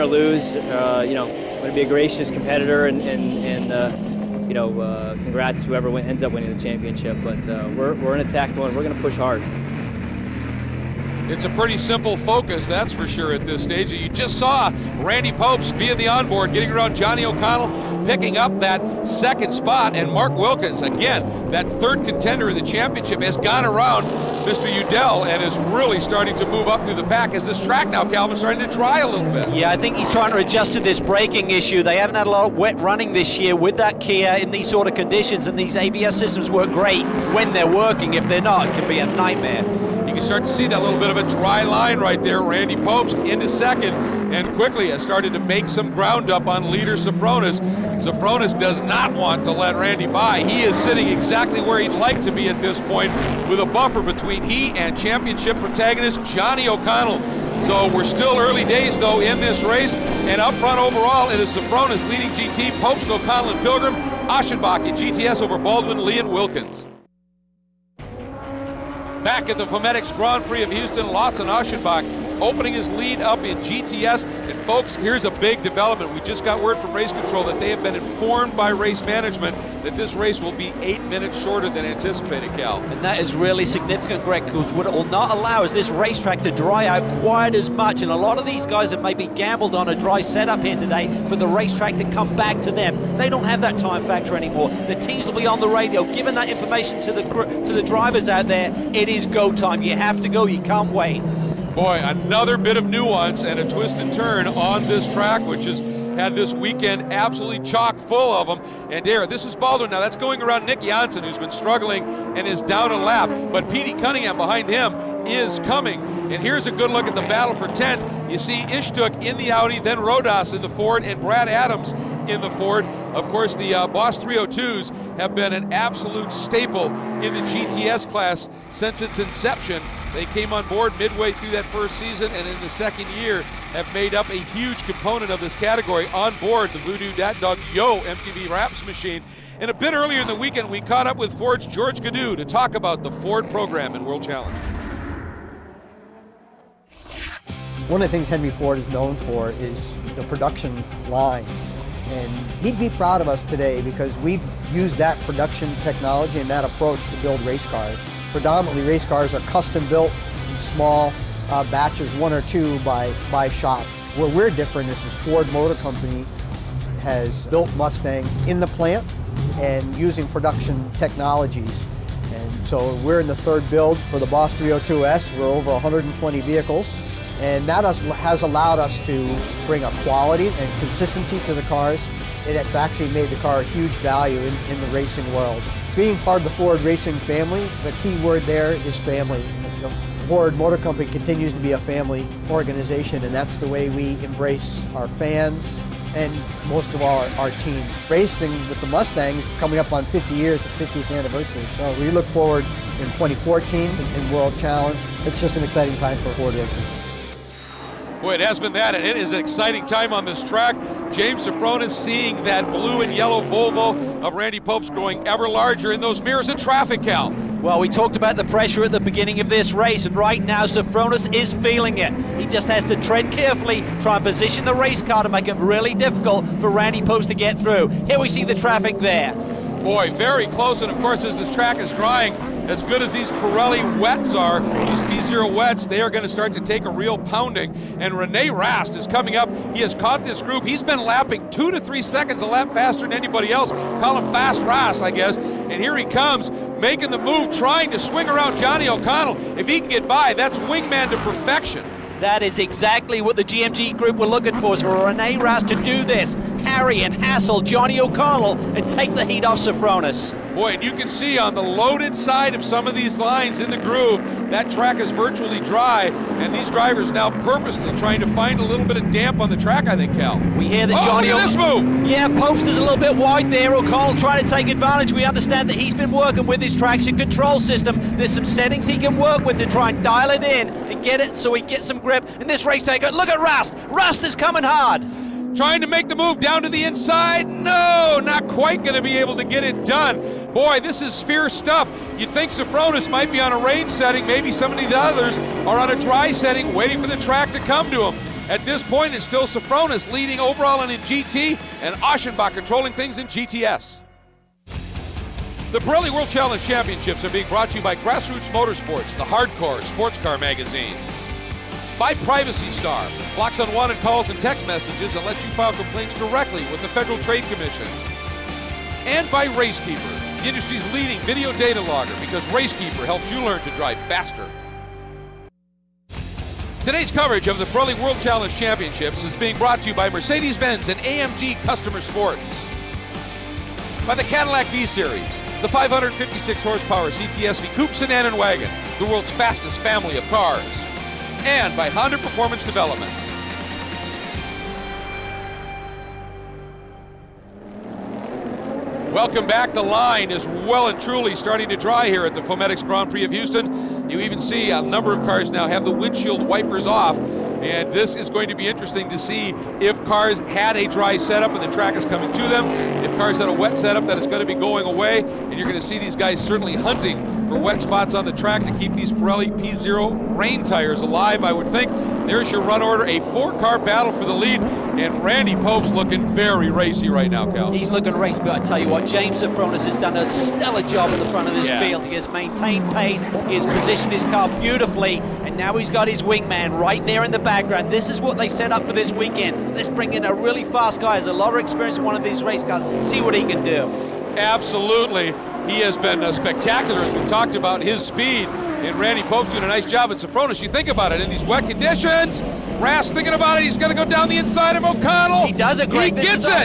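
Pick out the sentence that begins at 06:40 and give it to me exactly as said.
You think about it, in these wet conditions, Brass thinking about it, he's going to go down the inside of O'Connell.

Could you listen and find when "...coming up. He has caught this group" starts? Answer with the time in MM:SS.
03:59.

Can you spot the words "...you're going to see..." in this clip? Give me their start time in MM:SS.
06:05.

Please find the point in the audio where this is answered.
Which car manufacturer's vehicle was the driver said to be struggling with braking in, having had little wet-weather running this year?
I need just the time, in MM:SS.
00:33.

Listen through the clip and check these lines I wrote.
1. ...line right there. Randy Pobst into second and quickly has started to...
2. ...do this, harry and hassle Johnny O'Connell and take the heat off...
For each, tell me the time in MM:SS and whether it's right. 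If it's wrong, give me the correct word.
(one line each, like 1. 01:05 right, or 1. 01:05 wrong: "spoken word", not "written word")
1. 00:41 right
2. 04:15 right.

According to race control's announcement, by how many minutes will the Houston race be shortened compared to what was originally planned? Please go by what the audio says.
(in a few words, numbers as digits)
8 minutes.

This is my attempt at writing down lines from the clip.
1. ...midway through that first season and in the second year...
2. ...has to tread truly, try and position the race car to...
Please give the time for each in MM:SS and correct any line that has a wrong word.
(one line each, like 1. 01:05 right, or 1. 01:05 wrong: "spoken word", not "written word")
1. 02:10 right
2. 03:42 wrong: "carefully", not "truly".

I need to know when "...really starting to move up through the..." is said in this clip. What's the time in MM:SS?
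00:25.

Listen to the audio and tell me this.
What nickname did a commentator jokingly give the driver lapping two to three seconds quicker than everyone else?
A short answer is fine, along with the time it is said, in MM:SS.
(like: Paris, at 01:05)
Fast Rast, at 04:04.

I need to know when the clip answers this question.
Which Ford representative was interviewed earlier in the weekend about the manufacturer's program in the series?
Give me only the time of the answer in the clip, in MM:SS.
02:21.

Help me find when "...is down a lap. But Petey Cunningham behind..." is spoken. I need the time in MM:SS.
01:52.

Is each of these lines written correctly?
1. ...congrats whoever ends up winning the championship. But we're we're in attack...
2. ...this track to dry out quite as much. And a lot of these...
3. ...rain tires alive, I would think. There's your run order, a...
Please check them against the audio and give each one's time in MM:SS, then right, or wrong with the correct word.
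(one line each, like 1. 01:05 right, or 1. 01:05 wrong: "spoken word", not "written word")
1. 00:05 right
2. 01:25 wrong: "racetrack", not "track"
3. 06:10 right.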